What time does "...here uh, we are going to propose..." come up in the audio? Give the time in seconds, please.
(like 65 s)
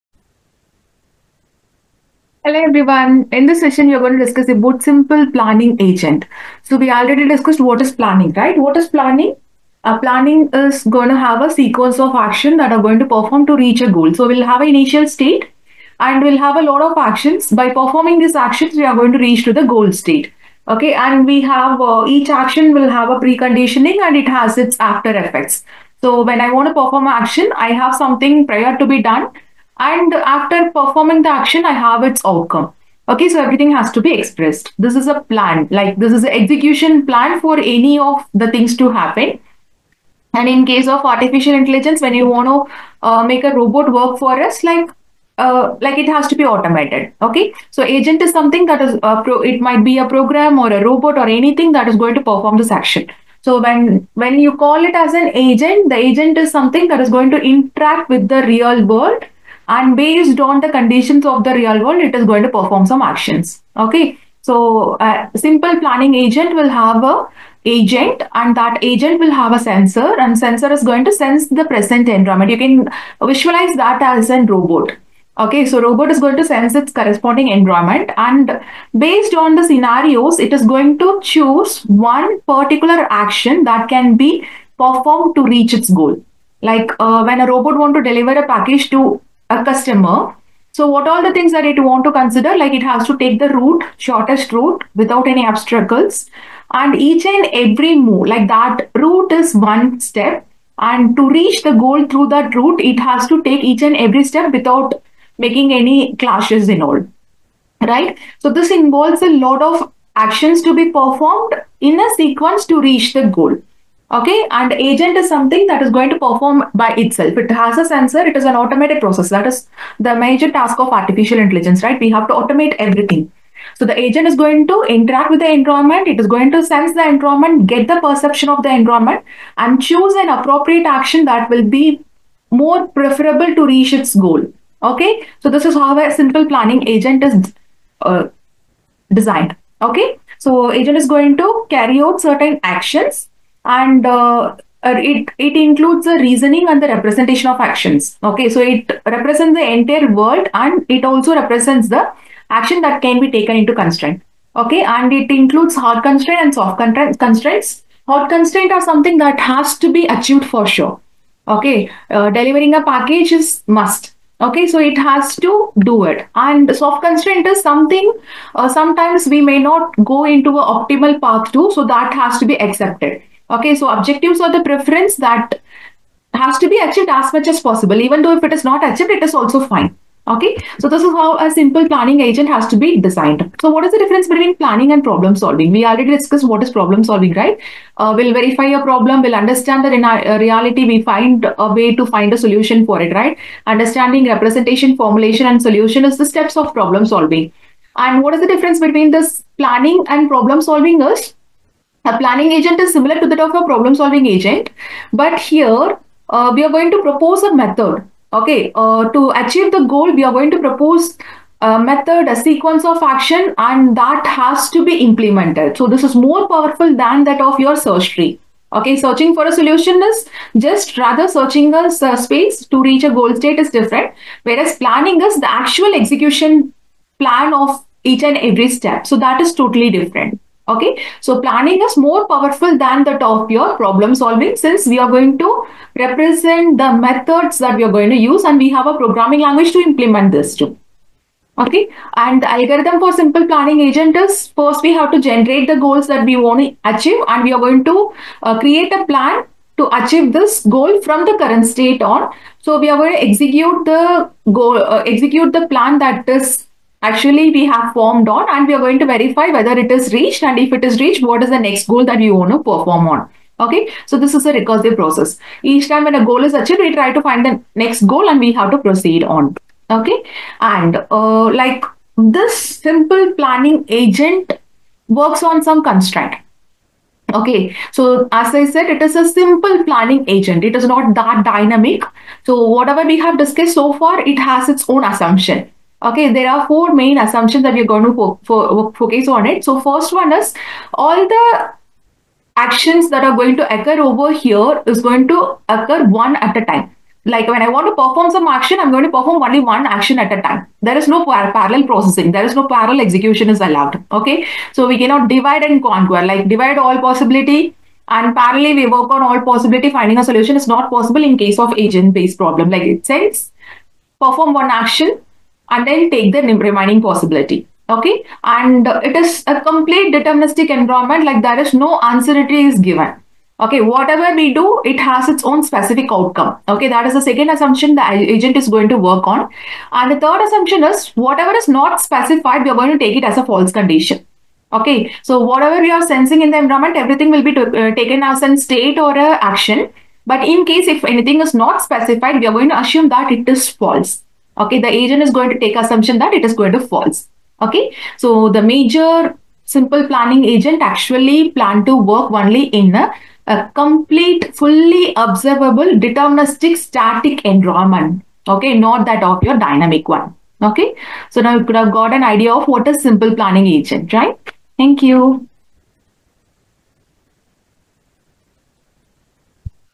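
205 s.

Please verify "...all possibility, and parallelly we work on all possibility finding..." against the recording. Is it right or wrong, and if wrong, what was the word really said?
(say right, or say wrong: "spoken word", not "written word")
right.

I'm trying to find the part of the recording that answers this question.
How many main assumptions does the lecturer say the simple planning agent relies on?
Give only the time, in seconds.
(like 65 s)
286 s.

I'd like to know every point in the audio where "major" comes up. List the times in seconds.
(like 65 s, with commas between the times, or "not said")
120 s, 348 s.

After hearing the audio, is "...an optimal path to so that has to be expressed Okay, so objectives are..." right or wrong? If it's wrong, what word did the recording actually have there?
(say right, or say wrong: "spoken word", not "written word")
wrong: "accepted", not "expressed".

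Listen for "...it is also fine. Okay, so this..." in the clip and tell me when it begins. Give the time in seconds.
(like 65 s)
179 s.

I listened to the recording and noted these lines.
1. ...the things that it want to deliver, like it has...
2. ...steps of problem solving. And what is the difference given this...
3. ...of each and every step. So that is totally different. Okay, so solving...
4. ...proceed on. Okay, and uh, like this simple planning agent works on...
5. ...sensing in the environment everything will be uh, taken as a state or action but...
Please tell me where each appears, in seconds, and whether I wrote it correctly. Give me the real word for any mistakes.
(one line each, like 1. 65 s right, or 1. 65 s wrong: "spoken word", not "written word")
1. 91 s wrong: "consider", not "deliver"
2. 196 s wrong: "between", not "given"
3. 227 s wrong: "planning", not "solving"
4. 268 s right
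5. 336 s right.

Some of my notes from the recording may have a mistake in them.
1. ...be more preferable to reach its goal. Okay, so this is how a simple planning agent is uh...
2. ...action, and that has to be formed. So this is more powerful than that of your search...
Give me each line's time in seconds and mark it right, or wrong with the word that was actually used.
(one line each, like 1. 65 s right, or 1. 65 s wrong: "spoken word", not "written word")
1. 131 s right
2. 213 s wrong: "implemented", not "formed".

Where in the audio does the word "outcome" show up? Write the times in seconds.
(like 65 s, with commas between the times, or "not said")
32 s, 326 s.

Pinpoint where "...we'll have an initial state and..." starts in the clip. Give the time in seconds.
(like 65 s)
14 s.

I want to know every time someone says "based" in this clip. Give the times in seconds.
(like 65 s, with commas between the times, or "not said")
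59 s, 78 s, 312 s.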